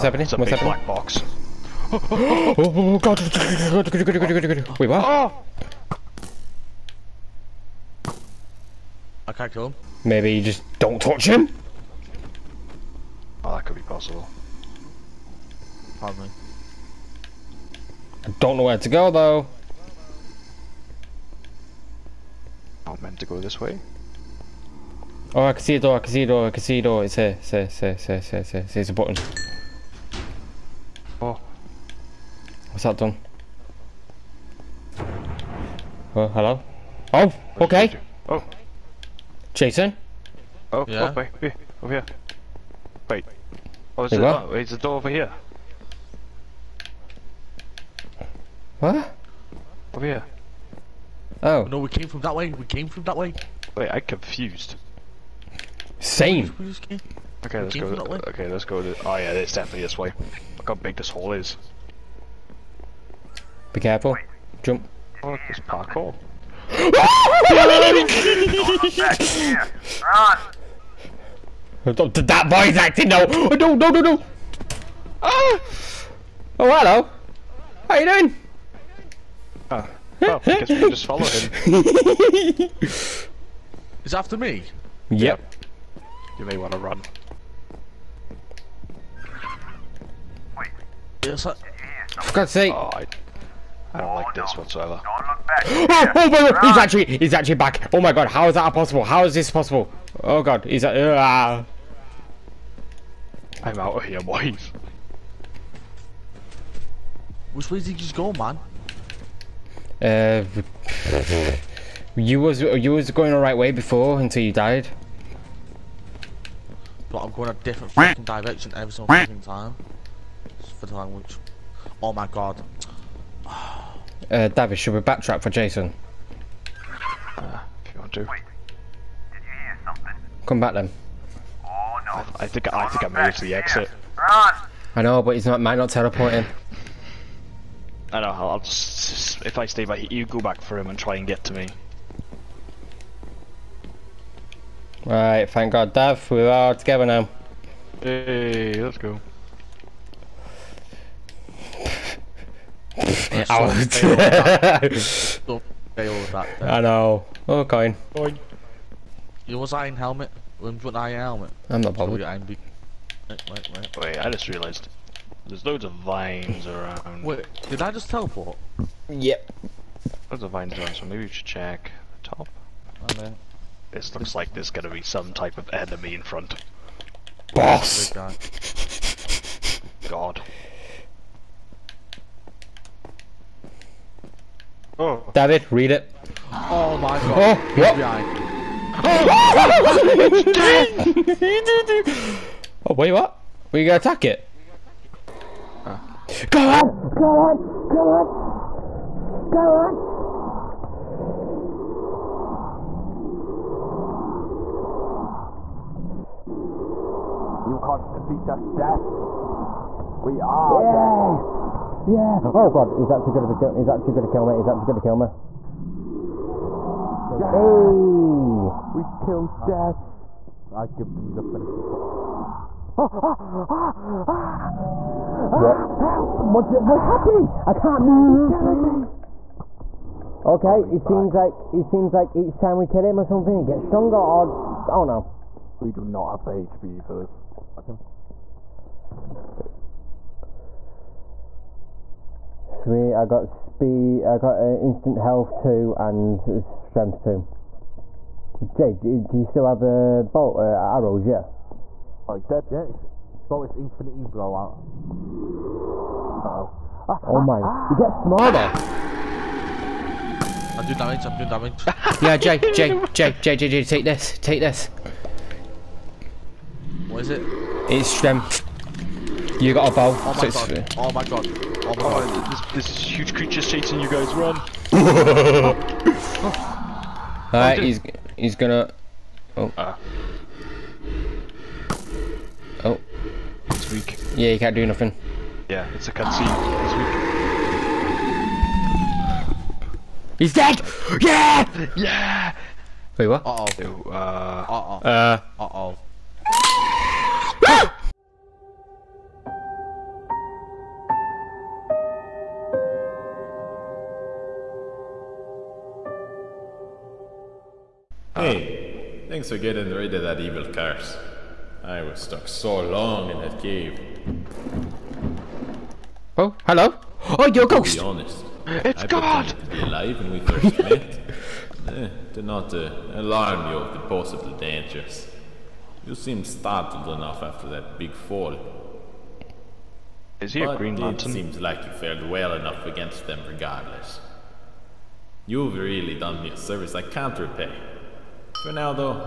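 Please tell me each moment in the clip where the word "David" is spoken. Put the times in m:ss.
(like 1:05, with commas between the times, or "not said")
2:04, 3:05.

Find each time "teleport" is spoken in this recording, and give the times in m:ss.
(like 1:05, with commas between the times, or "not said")
2:15, 2:48.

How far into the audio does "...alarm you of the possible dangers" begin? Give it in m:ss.
5:23.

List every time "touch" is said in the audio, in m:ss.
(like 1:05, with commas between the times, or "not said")
0:11, 3:41.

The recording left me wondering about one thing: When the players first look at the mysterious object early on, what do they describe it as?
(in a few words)
black box.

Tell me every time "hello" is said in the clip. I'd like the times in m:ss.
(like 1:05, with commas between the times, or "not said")
0:36, 1:16, 5:16.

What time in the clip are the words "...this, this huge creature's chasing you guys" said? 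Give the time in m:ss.
4:32.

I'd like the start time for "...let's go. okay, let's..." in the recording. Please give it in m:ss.
0:57.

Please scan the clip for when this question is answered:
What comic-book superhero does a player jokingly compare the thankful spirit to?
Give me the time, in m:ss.
5:30.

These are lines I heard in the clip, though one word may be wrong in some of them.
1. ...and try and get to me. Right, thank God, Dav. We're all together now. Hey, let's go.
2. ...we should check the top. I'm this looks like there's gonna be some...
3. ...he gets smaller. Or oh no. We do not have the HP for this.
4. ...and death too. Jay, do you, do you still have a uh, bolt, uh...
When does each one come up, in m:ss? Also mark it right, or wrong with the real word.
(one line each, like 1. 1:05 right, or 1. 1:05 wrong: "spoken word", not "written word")
1. 2:20 right
2. 2:51 right
3. 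3:53 wrong: "stronger", not "smaller"
4. 4:05 wrong: "strength", not "death".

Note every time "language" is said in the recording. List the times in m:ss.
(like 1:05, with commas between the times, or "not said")
2:00.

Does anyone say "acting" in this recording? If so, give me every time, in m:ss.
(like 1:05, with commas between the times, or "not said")
1:12.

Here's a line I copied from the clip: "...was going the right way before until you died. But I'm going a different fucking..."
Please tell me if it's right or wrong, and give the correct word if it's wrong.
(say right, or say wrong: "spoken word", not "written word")
right.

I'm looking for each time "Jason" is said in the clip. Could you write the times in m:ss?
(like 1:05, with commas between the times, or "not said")
0:39, 2:05.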